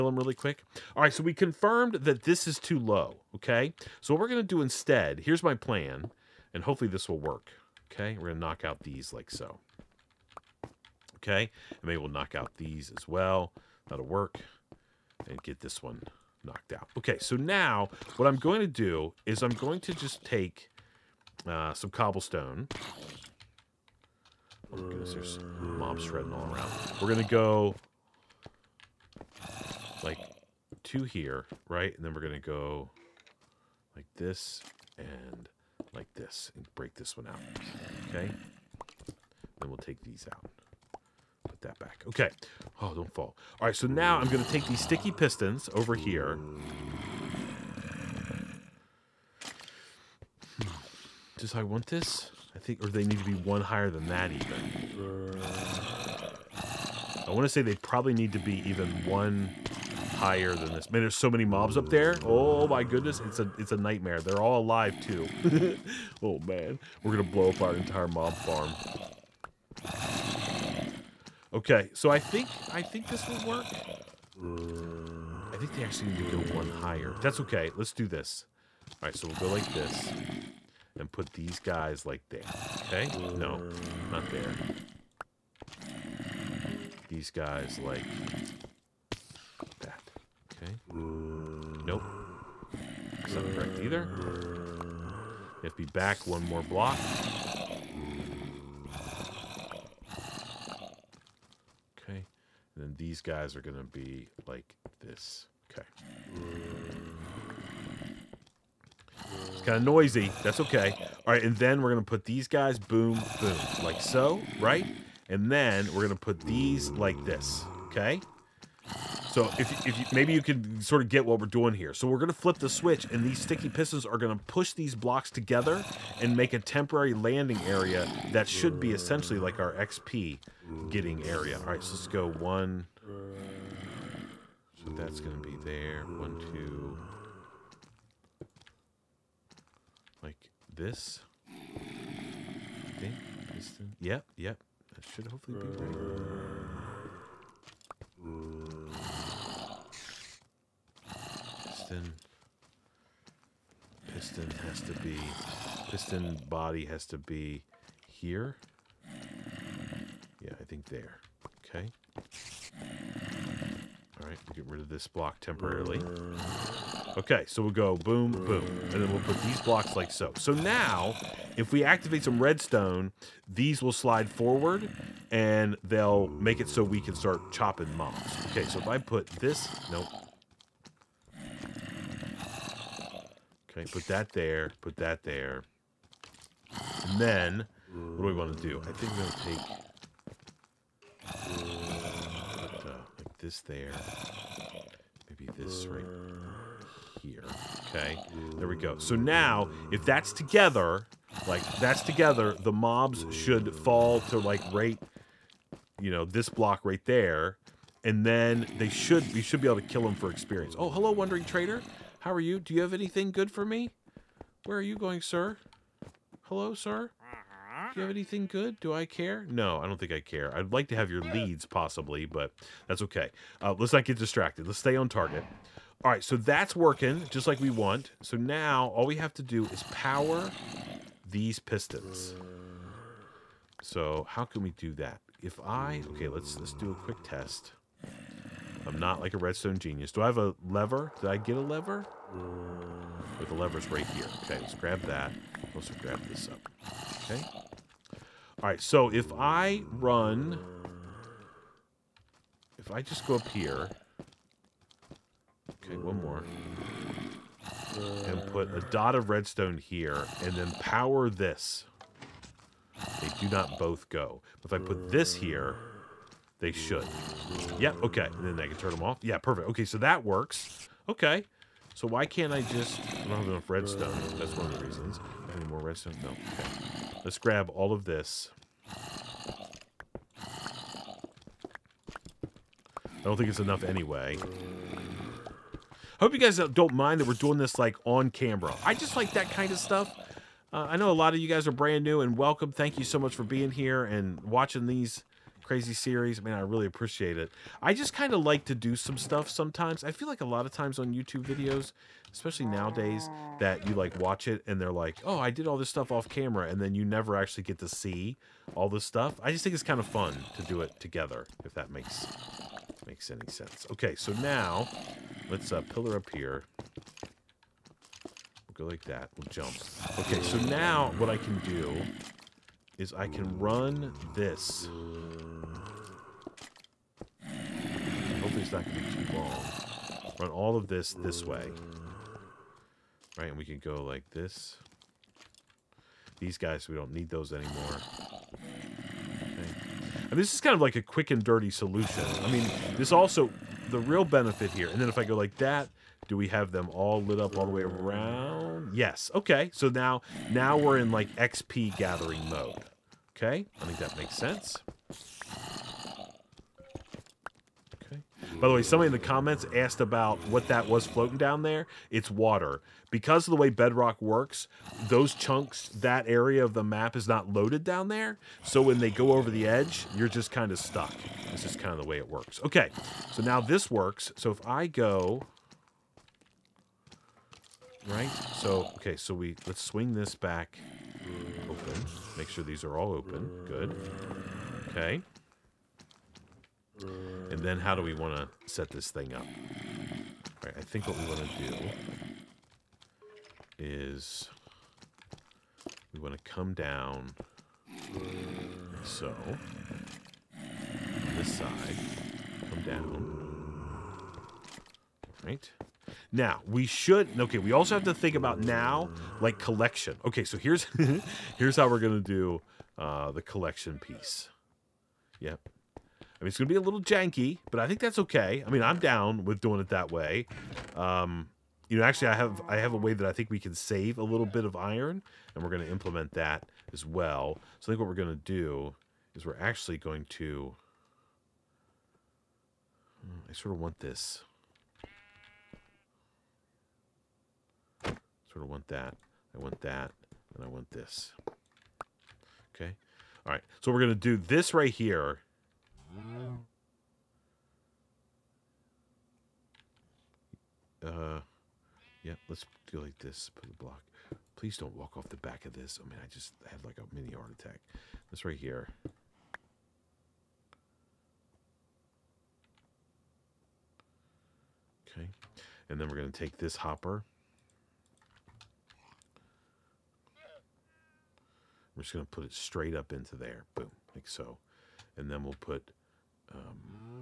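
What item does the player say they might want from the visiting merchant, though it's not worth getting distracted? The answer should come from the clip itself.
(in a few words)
Leads.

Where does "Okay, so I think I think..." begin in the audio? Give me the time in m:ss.
1:11.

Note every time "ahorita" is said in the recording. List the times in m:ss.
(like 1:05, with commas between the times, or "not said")
not said.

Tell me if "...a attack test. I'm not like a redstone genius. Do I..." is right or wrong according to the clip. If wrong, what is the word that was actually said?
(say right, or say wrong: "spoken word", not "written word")
wrong: "quick", not "attack".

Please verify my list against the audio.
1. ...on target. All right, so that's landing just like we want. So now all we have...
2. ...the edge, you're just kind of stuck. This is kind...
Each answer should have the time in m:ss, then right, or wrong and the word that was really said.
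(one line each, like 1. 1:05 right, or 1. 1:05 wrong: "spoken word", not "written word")
1. 3:44 wrong: "working", not "landing"
2. 6:09 right.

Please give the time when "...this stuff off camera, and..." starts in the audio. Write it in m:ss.
5:05.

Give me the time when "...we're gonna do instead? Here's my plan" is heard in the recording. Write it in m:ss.
0:04.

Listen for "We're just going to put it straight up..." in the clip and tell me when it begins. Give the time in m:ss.
7:51.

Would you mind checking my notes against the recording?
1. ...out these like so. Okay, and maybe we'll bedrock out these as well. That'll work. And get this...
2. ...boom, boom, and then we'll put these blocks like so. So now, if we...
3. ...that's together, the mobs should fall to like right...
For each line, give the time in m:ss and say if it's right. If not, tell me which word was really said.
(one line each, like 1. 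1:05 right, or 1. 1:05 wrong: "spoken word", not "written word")
1. 0:08 wrong: "knock", not "bedrock"
2. 2:47 right
3. 3:21 right.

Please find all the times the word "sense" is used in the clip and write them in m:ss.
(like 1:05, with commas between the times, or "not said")
5:13, 5:54.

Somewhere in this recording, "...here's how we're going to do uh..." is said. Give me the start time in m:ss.
6:51.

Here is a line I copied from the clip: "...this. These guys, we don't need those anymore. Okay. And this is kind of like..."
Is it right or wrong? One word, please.
right.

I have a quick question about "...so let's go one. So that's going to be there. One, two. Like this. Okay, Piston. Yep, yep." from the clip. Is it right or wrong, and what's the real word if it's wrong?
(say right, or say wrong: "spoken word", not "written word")
right.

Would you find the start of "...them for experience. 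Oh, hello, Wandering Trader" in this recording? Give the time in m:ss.
3:30.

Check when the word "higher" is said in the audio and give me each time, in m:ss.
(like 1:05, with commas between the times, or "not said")
0:53, 1:00, 1:16.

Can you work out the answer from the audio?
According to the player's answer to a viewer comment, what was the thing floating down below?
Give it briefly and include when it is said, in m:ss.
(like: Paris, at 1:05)
Water, at 6:02.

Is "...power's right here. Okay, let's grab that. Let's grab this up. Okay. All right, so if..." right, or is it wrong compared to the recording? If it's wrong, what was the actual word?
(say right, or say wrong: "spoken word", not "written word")
wrong: "lever", not "power".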